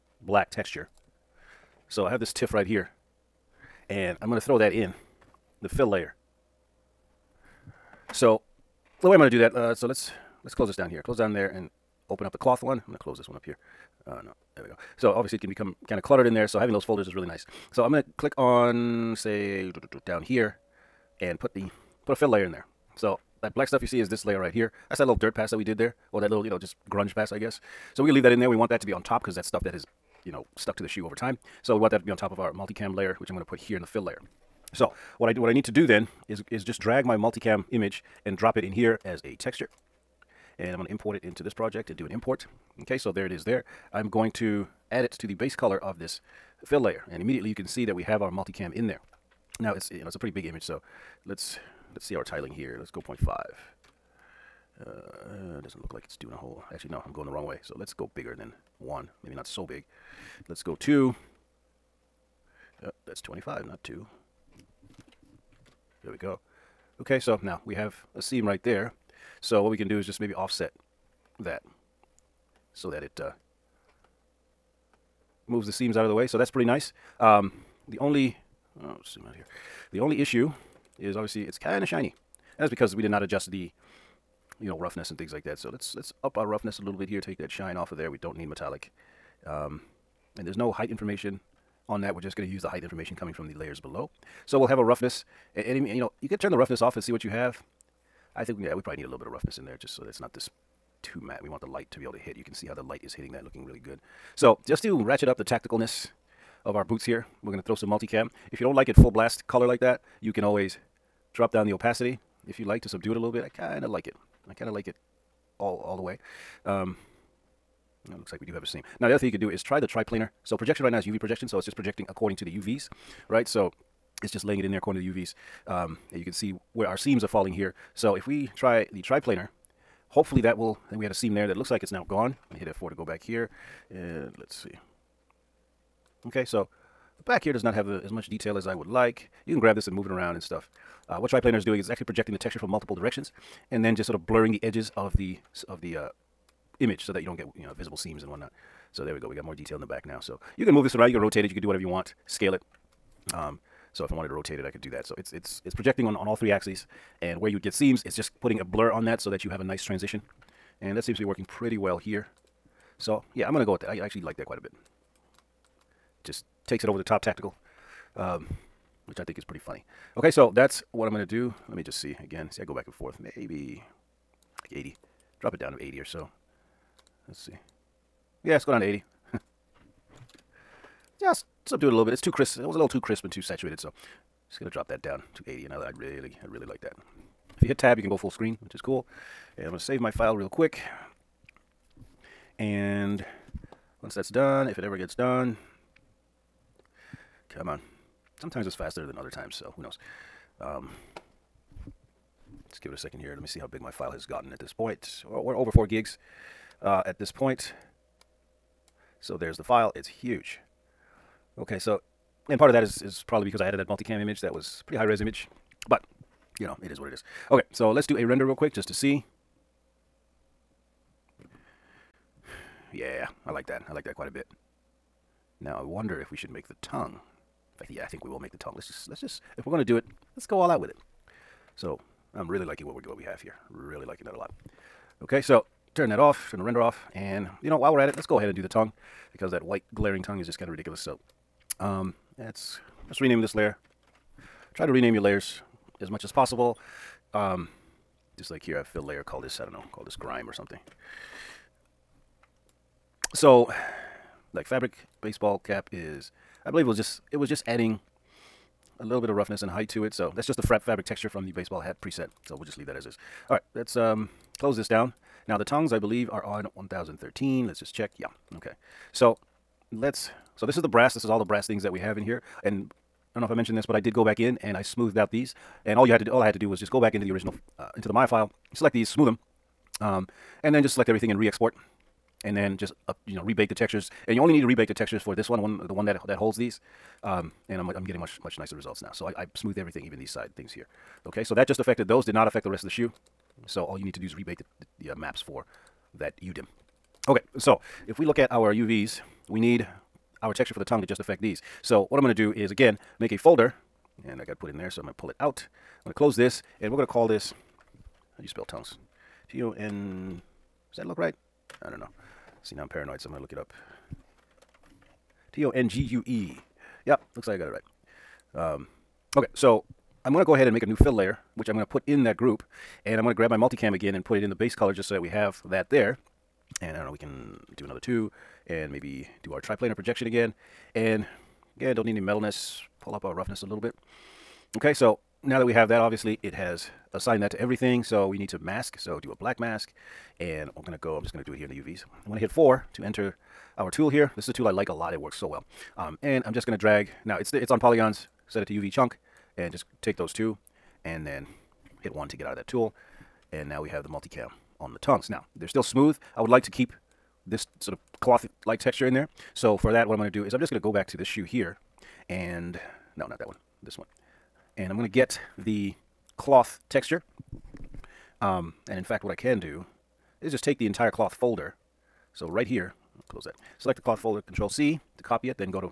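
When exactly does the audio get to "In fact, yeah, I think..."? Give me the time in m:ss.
3:47.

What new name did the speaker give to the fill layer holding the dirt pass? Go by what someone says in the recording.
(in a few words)
grime.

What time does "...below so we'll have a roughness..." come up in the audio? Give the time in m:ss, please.
1:33.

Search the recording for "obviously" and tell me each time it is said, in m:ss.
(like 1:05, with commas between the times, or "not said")
0:15, 1:21, 5:36.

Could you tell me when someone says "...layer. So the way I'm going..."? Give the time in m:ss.
0:05.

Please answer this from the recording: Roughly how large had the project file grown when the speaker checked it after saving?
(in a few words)
over 4 gigs.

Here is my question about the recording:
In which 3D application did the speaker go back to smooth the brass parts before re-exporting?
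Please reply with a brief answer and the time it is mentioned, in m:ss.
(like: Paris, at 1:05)
Maya, at 4:38.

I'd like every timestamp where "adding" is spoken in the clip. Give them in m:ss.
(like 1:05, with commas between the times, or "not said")
4:17.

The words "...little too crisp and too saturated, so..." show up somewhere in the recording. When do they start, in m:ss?
3:02.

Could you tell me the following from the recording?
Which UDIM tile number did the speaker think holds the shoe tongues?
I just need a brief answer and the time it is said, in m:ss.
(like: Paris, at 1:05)
1013, at 4:26.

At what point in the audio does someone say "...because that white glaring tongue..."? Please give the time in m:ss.
3:59.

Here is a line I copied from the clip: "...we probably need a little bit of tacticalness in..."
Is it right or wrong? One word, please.
wrong.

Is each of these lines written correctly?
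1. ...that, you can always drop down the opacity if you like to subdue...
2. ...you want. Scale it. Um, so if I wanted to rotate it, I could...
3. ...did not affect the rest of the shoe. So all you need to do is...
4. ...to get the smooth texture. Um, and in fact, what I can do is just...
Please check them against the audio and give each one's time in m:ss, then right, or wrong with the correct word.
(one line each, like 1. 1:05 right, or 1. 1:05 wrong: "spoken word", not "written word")
1. 1:49 right
2. 2:31 right
3. 4:52 right
4. 6:05 wrong: "cloth", not "smooth".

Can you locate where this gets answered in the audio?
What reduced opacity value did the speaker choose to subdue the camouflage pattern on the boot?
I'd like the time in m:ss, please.
2:55.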